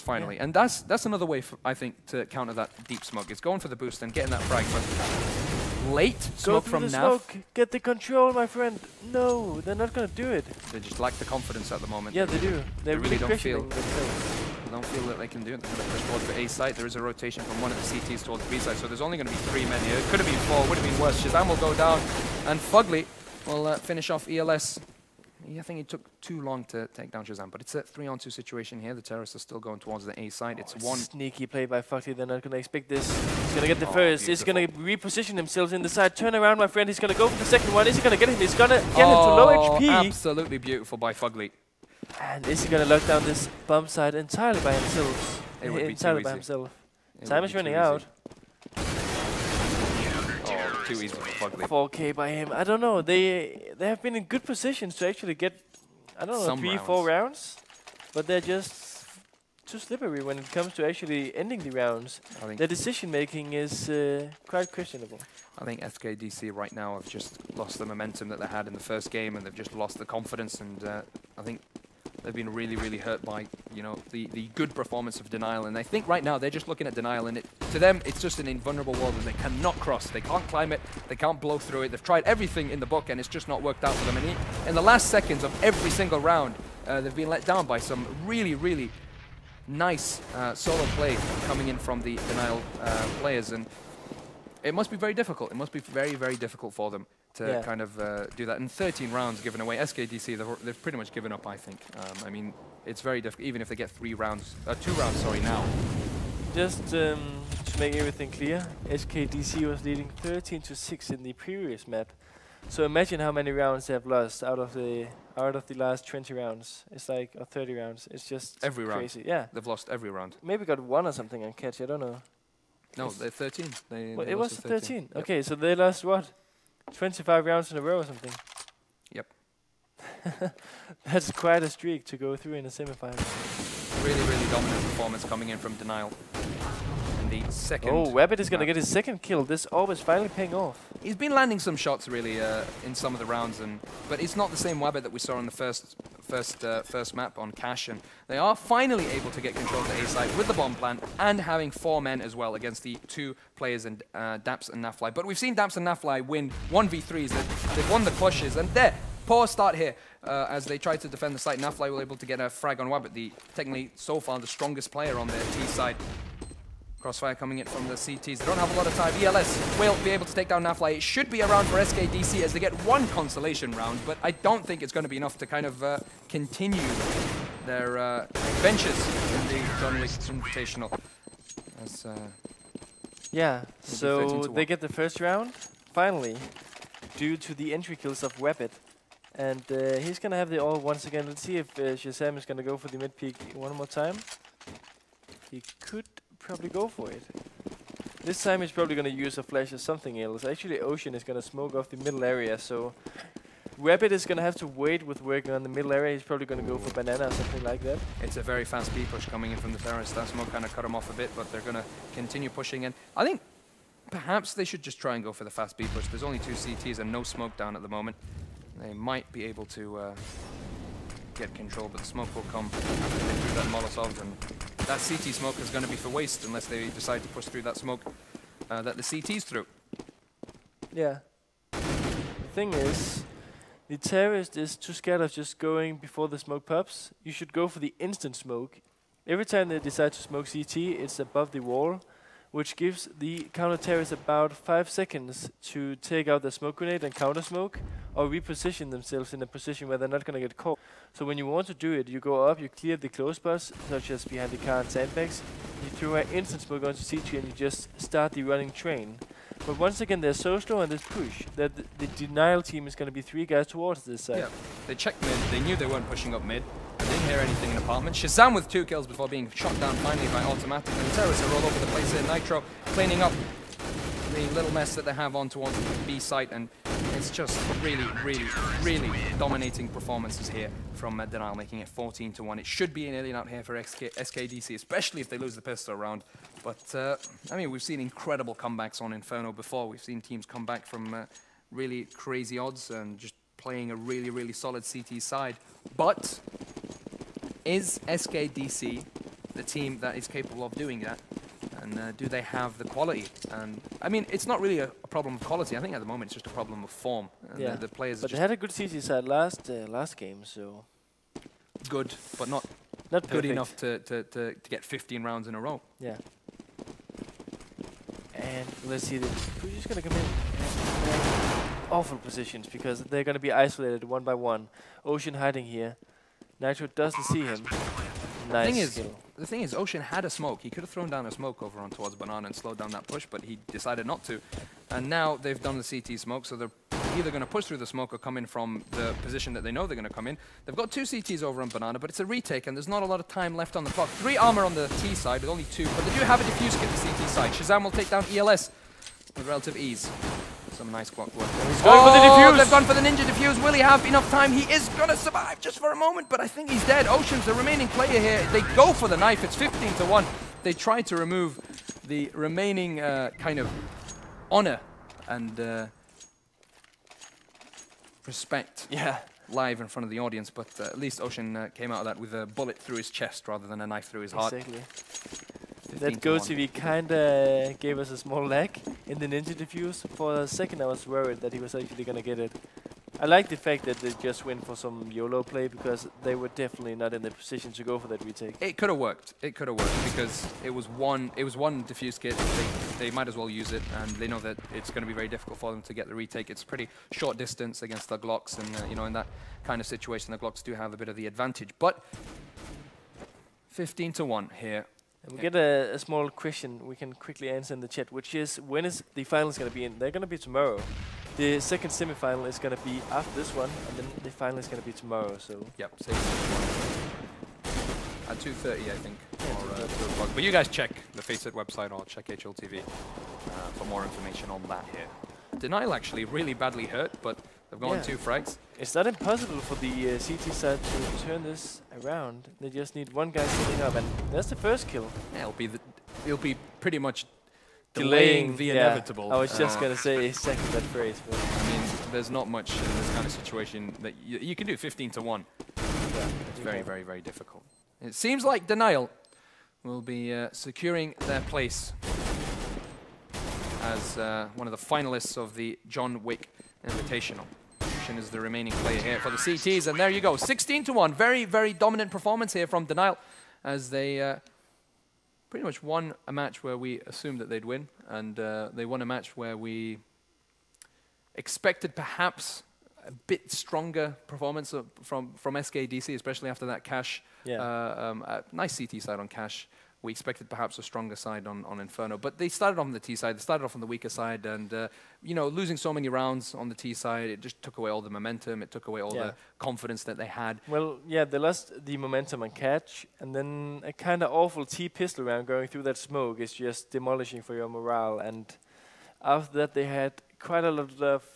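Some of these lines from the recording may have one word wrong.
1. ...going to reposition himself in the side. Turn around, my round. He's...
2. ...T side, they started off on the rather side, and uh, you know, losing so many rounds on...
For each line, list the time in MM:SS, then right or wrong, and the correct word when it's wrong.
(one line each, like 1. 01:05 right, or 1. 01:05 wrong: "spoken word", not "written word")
1. 00:34 wrong: "friend", not "round"
2. 08:02 wrong: "weaker", not "rather".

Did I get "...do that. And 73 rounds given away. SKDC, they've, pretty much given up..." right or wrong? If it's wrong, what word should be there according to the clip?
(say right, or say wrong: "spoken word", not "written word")
wrong: "13", not "73".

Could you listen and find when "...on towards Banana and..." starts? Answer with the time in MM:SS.
05:31.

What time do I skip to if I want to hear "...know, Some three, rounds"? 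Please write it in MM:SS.
00:56.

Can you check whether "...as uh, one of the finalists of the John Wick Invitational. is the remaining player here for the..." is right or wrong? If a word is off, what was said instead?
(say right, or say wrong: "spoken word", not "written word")
right.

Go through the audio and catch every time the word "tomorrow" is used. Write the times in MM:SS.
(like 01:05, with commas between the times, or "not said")
06:50, 06:54.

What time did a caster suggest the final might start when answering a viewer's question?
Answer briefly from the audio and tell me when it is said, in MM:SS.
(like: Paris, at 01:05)
2.30, at 06:58.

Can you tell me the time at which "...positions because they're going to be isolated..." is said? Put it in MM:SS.
05:22.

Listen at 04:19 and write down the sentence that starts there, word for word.
But once again, they're so slow they this push that the denial team is going to be three guys towards this side.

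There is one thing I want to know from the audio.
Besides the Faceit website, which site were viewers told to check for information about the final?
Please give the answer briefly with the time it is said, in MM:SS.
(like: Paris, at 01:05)
HLTV, at 07:02.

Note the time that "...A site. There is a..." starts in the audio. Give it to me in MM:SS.
00:16.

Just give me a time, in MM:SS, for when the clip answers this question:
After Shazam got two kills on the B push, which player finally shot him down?
04:30.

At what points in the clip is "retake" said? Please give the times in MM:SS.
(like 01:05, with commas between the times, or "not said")
05:42, 06:28, 06:36.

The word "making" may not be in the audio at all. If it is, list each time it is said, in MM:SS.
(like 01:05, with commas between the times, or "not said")
01:02, 04:41.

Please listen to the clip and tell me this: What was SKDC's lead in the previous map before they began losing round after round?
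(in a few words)
13 to 6.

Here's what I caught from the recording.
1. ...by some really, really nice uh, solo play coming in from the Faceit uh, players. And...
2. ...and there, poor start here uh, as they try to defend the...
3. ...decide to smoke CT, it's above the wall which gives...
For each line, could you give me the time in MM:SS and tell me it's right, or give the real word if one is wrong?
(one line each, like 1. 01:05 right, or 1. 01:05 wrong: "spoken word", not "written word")
1. 01:27 wrong: "Denial", not "Faceit"
2. 02:38 right
3. 03:59 right.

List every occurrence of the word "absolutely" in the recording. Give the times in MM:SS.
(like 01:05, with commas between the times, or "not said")
00:40.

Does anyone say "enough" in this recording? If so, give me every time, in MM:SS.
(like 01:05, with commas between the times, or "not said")
02:55, 05:13, 05:54.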